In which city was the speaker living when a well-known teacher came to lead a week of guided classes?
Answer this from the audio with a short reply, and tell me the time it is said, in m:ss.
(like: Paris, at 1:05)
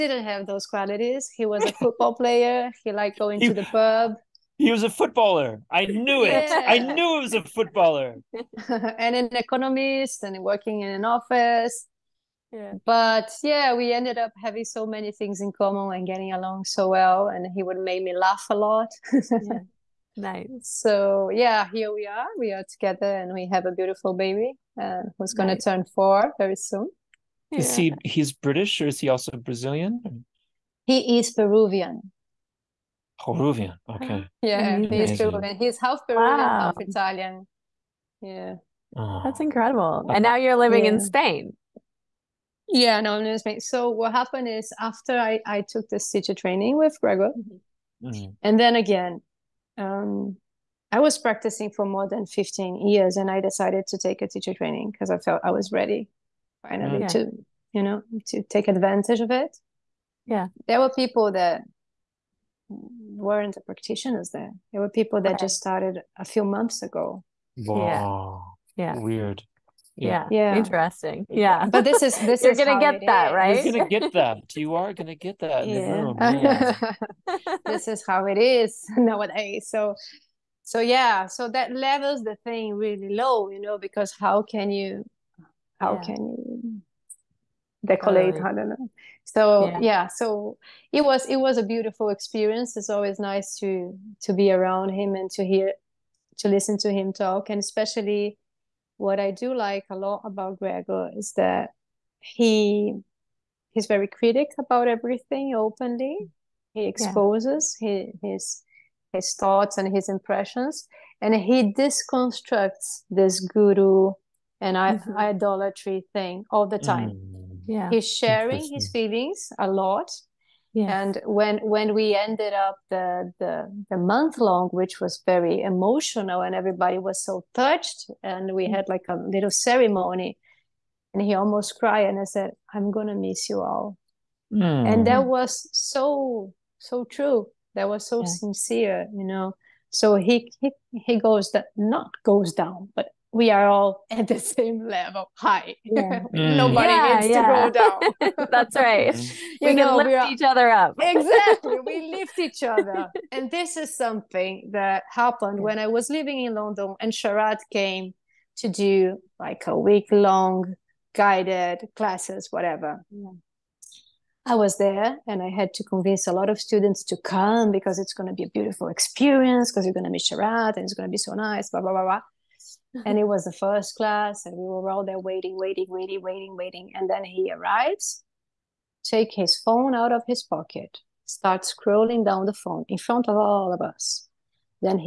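London, at 2:36.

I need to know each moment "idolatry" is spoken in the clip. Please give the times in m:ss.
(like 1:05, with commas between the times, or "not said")
1:55.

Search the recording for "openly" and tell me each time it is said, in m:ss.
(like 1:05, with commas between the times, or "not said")
1:45.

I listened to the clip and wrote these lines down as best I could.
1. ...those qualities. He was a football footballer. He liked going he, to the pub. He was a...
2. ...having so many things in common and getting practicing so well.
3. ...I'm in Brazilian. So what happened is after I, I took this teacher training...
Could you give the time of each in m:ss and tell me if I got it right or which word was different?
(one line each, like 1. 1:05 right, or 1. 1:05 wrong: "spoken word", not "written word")
1. 0:00 wrong: "player", not "footballer"
2. 0:14 wrong: "along", not "practicing"
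3. 0:43 wrong: "Spain", not "Brazilian".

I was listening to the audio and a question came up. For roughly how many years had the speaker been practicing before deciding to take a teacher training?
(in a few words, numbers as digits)
more than 15.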